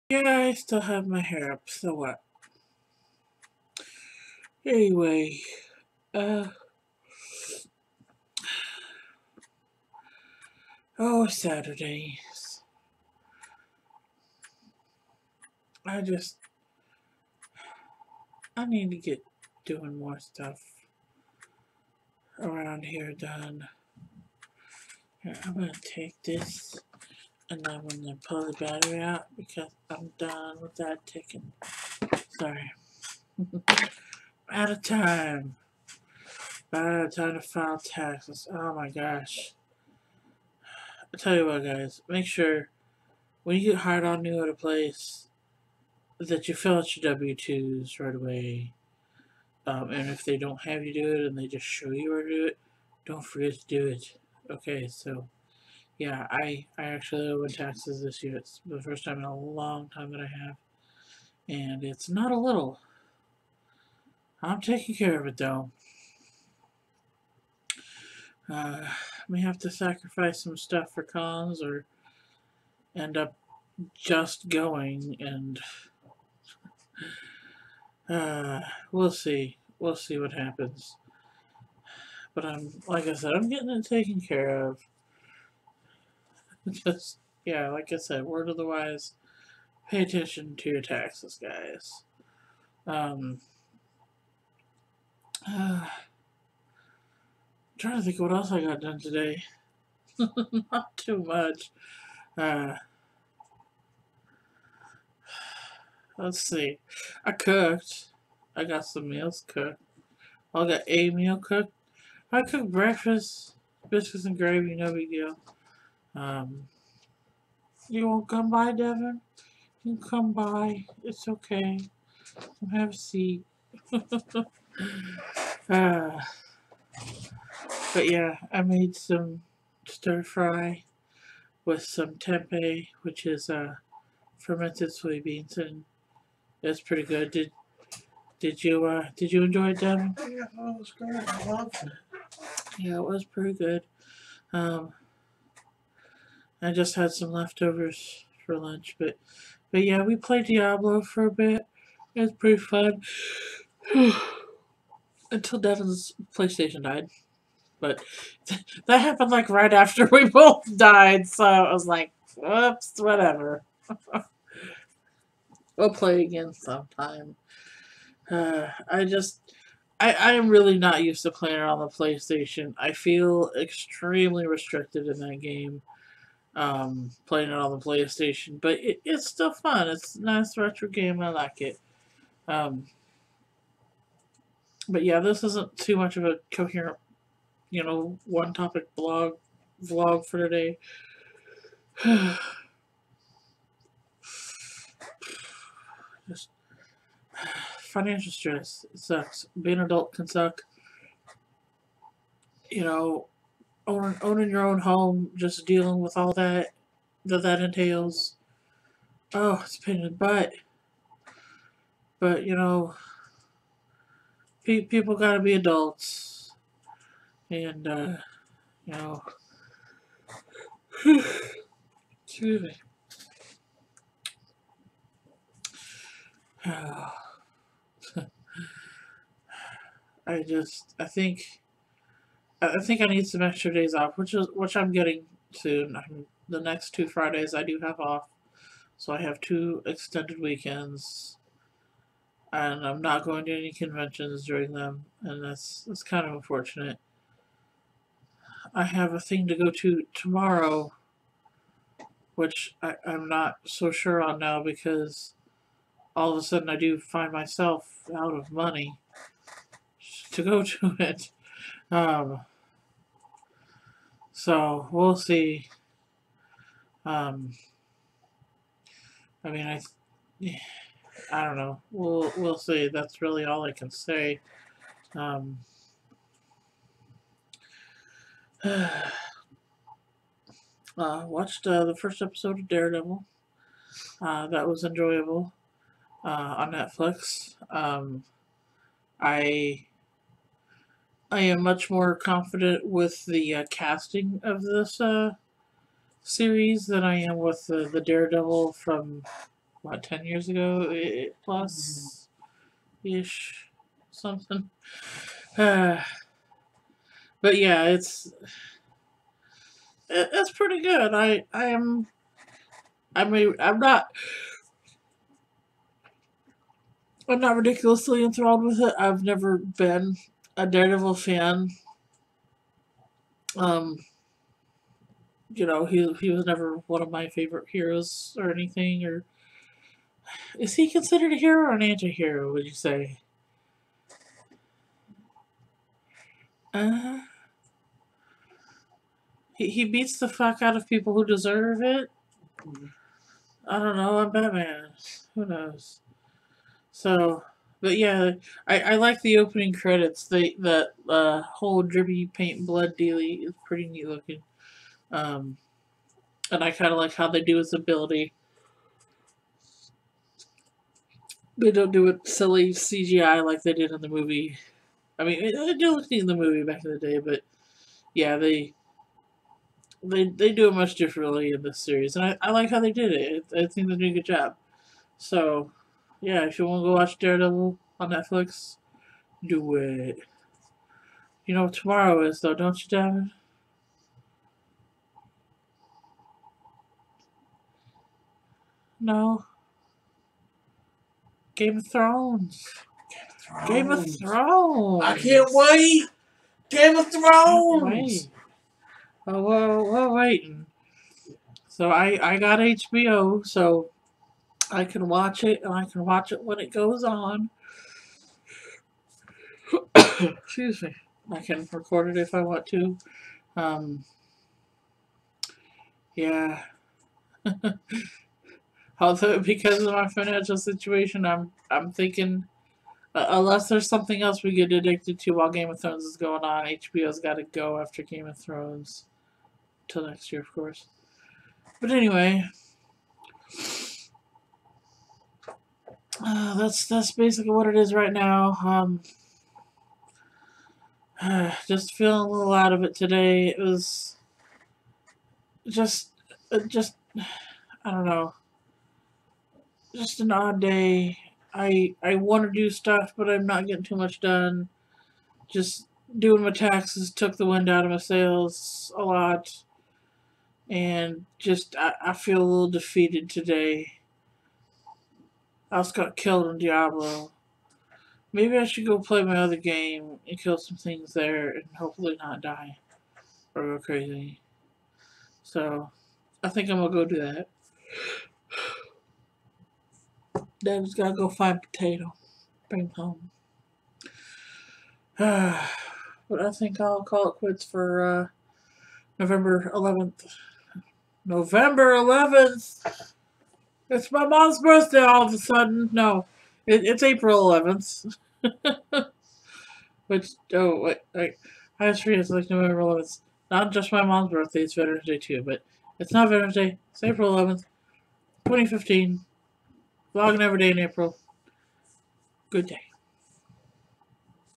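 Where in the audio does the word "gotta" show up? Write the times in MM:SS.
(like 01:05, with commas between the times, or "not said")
03:35, 08:00.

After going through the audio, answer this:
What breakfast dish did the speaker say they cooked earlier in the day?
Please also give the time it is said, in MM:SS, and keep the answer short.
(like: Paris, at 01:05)
biscuits and gravy, at 01:53.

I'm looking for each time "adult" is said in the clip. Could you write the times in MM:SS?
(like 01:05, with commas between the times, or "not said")
03:19, 03:35.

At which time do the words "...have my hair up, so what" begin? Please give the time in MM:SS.
00:00.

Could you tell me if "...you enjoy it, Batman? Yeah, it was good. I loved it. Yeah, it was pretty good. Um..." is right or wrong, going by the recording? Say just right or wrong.
wrong.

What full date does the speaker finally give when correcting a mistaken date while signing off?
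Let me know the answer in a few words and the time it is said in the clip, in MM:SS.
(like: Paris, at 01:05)
April 11th, 2015, at 08:27.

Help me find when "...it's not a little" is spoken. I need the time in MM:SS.
01:01.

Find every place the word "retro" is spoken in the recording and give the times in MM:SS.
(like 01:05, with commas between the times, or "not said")
03:00.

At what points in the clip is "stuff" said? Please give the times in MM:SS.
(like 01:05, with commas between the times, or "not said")
00:20, 01:10, 07:32.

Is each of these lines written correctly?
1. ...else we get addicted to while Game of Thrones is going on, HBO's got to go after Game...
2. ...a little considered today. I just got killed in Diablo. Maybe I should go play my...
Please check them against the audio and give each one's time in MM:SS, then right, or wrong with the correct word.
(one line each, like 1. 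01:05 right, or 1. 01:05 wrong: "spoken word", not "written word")
1. 07:04 right
2. 07:42 wrong: "defeated", not "considered".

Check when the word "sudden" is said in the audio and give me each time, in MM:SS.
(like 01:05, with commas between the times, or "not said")
04:16, 08:15.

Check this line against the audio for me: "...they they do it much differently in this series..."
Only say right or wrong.
right.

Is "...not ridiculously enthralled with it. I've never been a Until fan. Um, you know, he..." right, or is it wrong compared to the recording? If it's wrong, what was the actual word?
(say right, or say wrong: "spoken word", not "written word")
wrong: "Daredevil", not "Until".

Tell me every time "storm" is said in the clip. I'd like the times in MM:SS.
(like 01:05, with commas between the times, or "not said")
not said.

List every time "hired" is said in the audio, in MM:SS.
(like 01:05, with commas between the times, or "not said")
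00:43.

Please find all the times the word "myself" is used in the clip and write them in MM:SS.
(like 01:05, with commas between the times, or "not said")
04:17.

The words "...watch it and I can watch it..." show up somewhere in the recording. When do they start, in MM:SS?
06:45.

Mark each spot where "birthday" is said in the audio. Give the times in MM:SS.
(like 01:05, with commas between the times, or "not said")
08:14, 08:24.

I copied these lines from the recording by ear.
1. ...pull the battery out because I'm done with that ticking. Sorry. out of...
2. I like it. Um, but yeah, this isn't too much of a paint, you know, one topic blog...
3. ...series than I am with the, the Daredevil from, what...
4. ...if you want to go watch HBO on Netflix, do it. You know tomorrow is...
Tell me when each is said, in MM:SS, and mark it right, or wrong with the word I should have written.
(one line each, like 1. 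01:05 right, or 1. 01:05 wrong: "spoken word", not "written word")
1. 00:28 right
2. 03:01 wrong: "coherent", not "paint"
3. 04:56 right
4. 06:16 wrong: "Daredevil", not "HBO".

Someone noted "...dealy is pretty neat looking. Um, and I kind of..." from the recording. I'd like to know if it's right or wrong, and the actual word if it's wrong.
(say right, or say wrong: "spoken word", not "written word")
right.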